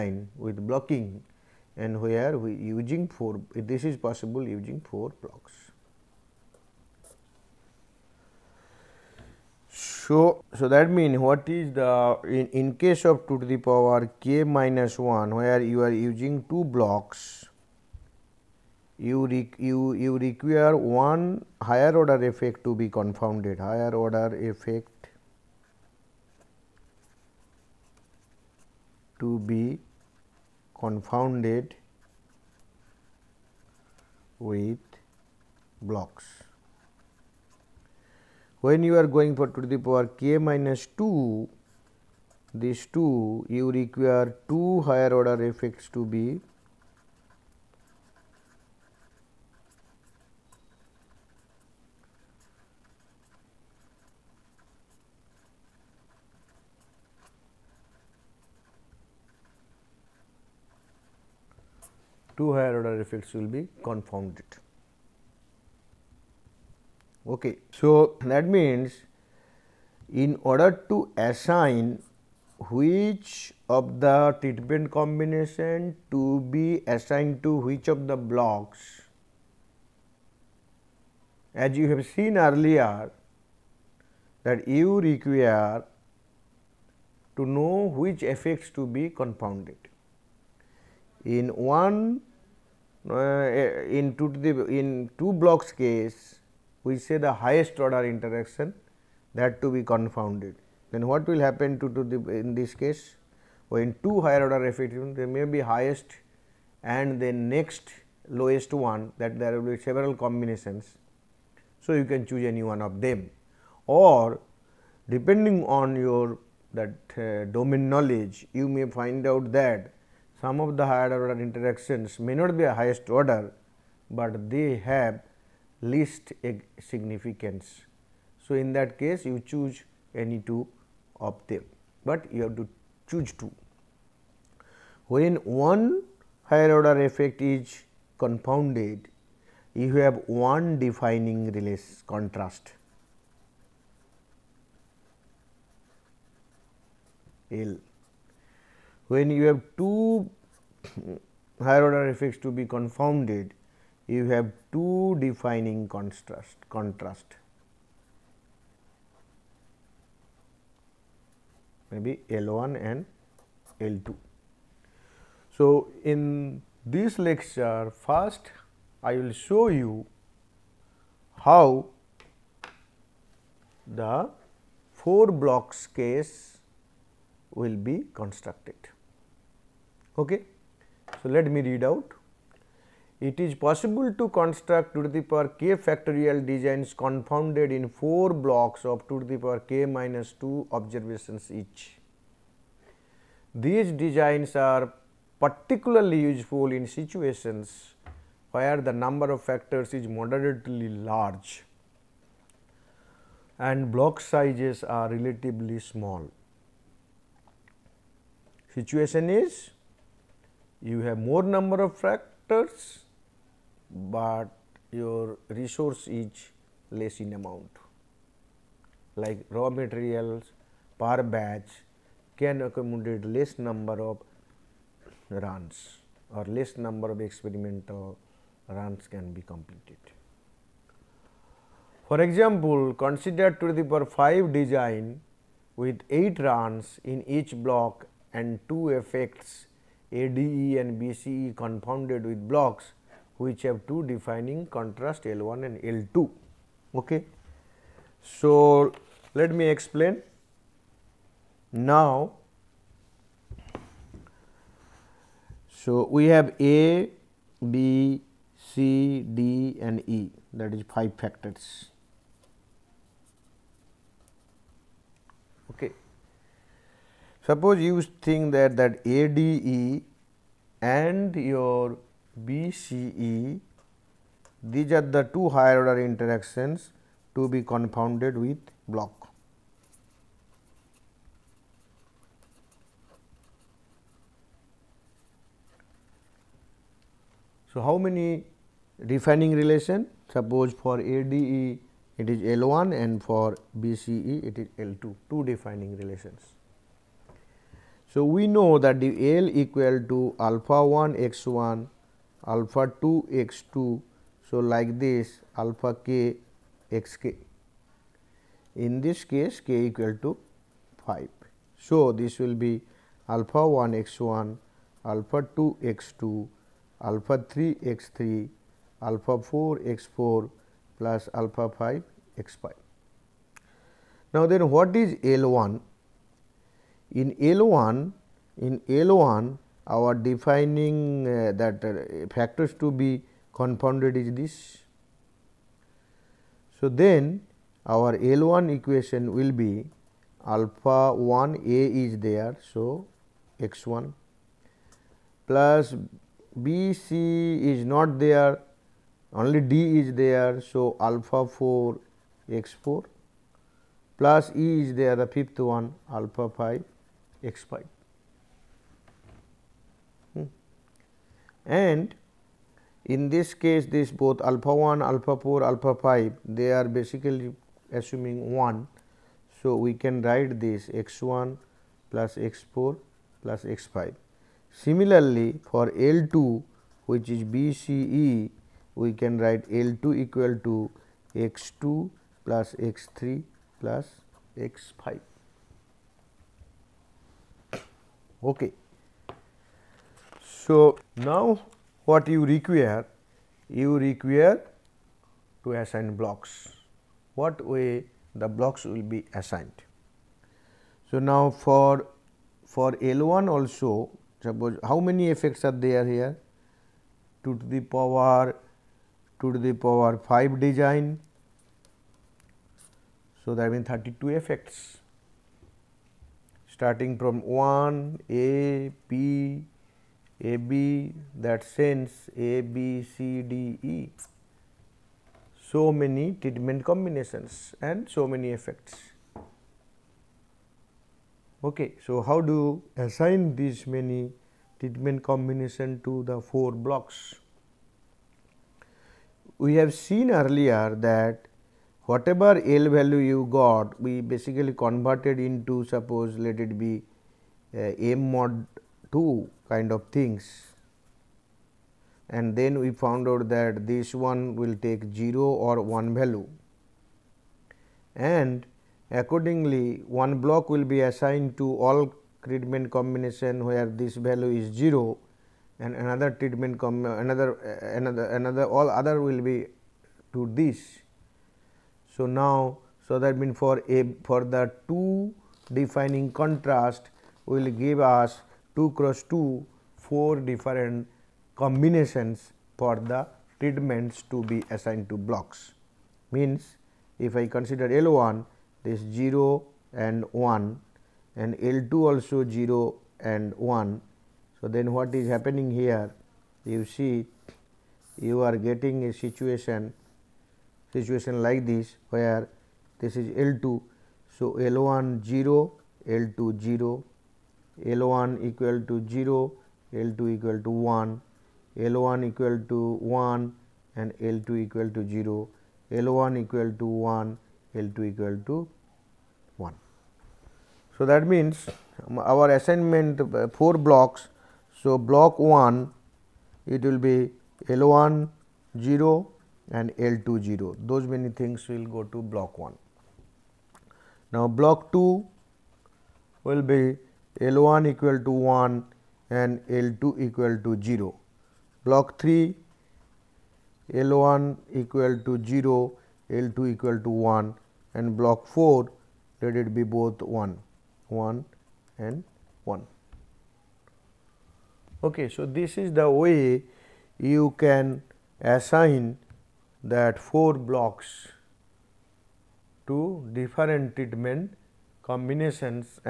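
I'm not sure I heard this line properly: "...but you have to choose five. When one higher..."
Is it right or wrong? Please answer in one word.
wrong.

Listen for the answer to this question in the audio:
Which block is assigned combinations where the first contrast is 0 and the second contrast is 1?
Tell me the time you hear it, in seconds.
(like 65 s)
541 s.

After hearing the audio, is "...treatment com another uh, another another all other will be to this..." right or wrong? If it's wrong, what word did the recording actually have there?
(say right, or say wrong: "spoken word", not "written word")
right.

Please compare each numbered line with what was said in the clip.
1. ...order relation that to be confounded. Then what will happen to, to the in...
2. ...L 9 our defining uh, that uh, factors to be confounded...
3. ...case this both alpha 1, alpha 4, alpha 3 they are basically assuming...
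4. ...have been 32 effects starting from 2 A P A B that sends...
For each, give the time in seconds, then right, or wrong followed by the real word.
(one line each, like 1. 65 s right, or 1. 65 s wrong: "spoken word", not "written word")
1. 97 s wrong: "interaction", not "relation"
2. 328 s wrong: "1", not "9"
3. 363 s wrong: "5", not "3"
4. 413 s wrong: "1", not "2".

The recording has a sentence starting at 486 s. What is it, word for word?
Means if I consider L 1 this 0 and 1 and L 2 also 0 and 1.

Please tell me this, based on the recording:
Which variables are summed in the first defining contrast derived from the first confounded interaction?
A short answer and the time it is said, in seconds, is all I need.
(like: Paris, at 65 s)
x1 + x4 + x5, at 371 s.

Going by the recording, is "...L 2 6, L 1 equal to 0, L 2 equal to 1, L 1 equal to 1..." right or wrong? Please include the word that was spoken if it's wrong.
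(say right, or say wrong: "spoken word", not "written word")
wrong: "0", not "6".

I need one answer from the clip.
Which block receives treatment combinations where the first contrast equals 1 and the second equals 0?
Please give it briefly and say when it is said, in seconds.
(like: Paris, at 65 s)
Block 2, at 534 s.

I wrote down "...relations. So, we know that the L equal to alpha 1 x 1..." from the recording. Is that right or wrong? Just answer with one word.
right.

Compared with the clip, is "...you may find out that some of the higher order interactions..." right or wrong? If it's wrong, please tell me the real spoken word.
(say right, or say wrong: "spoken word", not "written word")
right.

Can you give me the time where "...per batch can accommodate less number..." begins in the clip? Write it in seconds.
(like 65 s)
220 s.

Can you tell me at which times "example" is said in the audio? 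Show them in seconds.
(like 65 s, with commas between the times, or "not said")
232 s.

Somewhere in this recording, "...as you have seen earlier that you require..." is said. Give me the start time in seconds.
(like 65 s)
81 s.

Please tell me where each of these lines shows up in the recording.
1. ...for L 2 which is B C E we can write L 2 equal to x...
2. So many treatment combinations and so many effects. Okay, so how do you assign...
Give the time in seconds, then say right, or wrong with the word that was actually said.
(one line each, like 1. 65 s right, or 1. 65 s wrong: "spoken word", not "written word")
1. 375 s right
2. 425 s right.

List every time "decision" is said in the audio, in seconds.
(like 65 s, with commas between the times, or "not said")
not said.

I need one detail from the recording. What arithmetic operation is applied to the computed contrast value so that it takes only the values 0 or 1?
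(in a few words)
mod 2.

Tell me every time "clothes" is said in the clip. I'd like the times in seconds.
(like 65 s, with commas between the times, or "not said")
not said.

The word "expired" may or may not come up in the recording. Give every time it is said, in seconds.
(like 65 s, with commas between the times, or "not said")
357 s.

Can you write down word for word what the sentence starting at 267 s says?
Suppose you think that that ADE and your BCE these are the two higher order interactions to be confounded with block.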